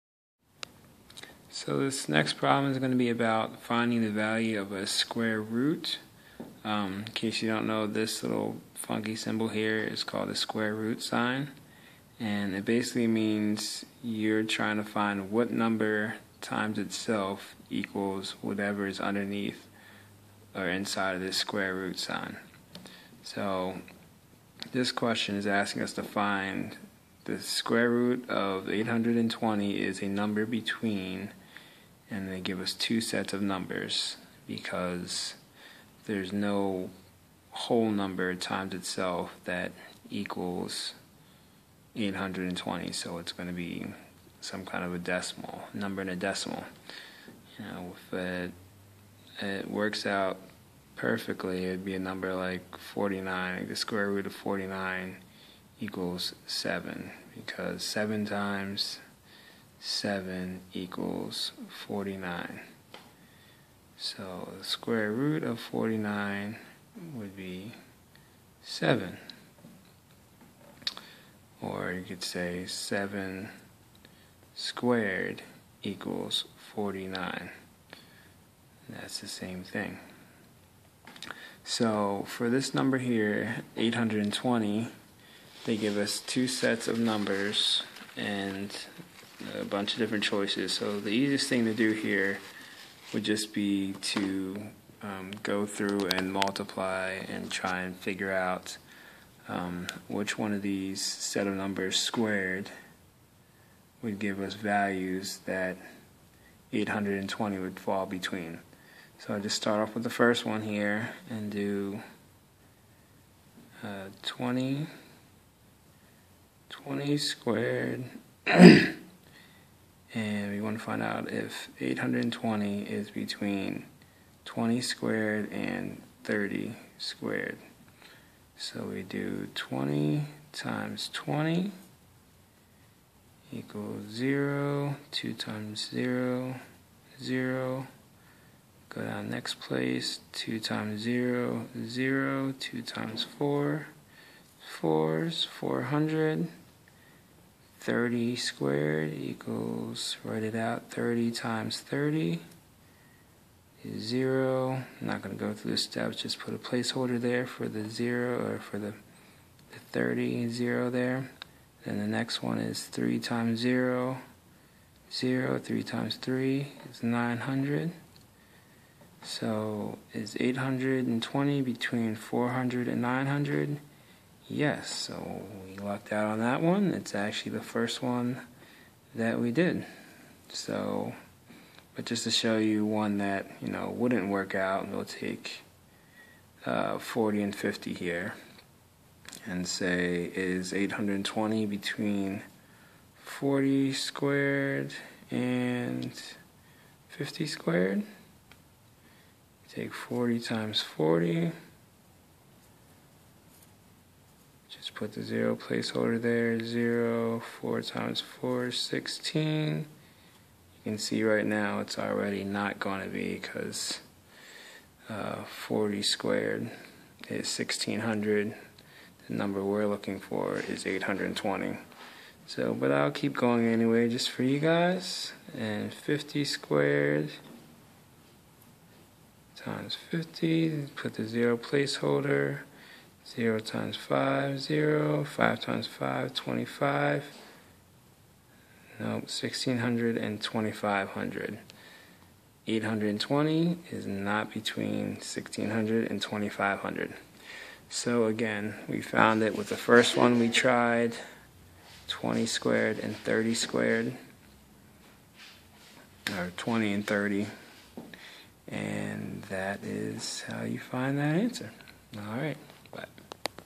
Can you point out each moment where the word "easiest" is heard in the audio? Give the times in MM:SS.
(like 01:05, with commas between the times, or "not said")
01:31.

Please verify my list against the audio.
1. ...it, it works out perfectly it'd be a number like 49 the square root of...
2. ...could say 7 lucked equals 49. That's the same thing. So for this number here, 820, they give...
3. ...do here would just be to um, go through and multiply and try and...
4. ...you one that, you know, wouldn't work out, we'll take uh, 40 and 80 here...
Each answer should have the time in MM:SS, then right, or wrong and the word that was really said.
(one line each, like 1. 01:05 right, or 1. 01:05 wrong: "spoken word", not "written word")
1. 00:48 right
2. 01:12 wrong: "squared", not "lucked"
3. 01:31 right
4. 03:02 wrong: "50", not "80".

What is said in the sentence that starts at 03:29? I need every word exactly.
You can see right now it's already not going to be because uh, 40 squared is 1600.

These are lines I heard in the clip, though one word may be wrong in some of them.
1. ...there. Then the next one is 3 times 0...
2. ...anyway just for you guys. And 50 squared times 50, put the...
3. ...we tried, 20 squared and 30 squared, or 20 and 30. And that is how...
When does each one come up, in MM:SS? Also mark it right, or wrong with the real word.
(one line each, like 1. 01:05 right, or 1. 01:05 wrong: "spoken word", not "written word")
1. 02:40 right
2. 03:43 right
3. 04:10 right.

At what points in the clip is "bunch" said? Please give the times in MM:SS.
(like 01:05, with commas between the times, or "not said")
01:29.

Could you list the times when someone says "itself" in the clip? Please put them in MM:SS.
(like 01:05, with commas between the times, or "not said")
00:16, 00:38.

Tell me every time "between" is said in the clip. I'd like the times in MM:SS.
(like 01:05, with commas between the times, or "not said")
00:30, 01:48, 02:03, 02:51, 03:11, 04:04.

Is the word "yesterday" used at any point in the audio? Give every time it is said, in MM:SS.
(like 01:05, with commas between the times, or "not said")
not said.